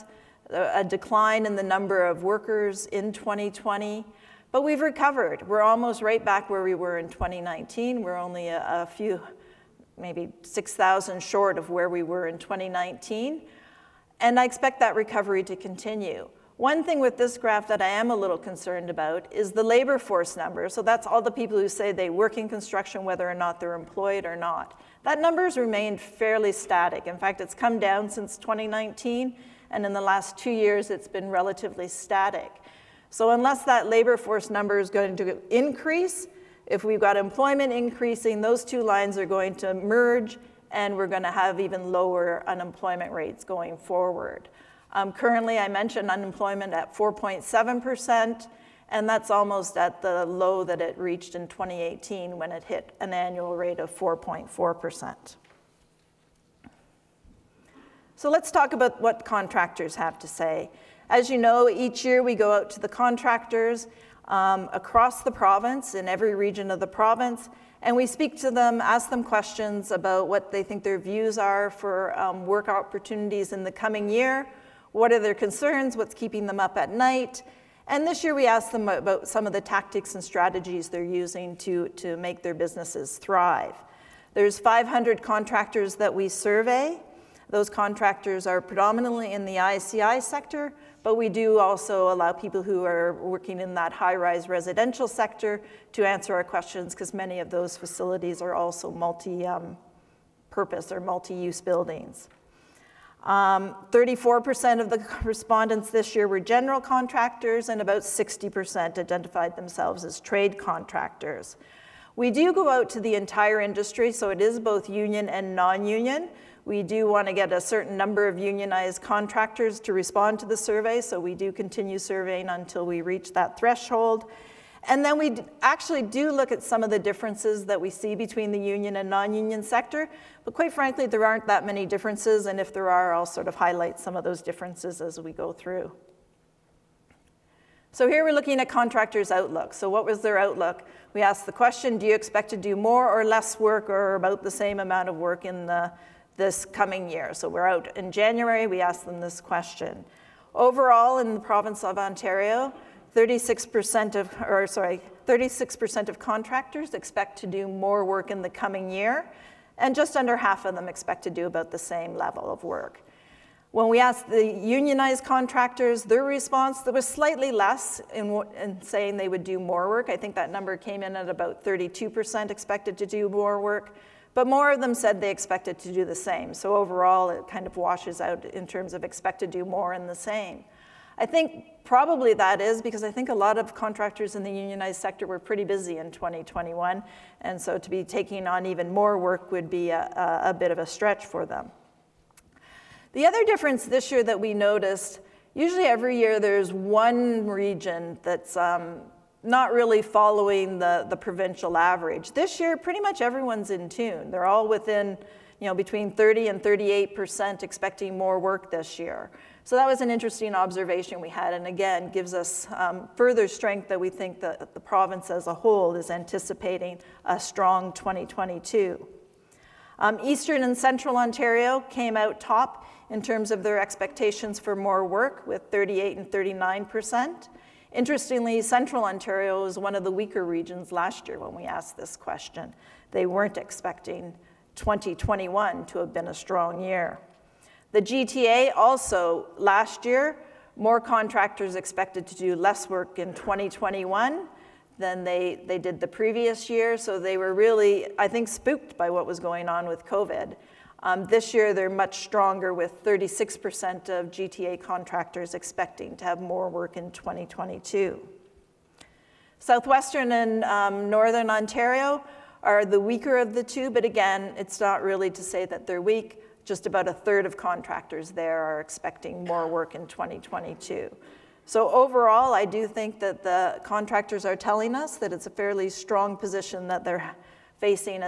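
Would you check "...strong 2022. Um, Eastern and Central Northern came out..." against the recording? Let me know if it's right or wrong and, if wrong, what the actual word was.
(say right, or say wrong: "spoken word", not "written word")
wrong: "Ontario", not "Northern".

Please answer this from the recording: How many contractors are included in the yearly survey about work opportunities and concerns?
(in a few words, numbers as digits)
500.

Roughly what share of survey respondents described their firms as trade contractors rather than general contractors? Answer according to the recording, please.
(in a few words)
60%.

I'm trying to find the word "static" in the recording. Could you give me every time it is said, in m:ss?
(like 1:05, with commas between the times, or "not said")
0:26, 0:31.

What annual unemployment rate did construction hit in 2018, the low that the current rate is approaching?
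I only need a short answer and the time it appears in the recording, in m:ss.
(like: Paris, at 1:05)
4.4%, at 0:53.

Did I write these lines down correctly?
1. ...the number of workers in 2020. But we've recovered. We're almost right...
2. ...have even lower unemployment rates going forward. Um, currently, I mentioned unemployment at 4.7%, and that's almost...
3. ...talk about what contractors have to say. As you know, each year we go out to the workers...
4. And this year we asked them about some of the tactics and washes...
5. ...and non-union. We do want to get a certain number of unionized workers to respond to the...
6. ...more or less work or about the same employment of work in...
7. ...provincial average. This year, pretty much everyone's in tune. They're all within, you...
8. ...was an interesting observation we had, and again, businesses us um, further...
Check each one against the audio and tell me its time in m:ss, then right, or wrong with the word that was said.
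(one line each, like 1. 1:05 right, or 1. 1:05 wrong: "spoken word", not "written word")
1. 0:01 right
2. 0:41 right
3. 0:58 wrong: "contractors", not "workers"
4. 1:17 wrong: "strategies", not "washes"
5. 1:55 wrong: "contractors", not "workers"
6. 2:22 wrong: "amount", not "employment"
7. 3:21 right
8. 3:29 wrong: "gives", not "businesses".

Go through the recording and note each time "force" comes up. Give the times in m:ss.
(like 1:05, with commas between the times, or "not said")
0:19, 0:34.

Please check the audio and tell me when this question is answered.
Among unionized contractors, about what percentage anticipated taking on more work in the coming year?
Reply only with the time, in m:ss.
2:51.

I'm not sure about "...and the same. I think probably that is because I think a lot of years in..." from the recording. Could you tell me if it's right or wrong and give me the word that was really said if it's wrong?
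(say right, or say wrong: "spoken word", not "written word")
wrong: "contractors", not "years".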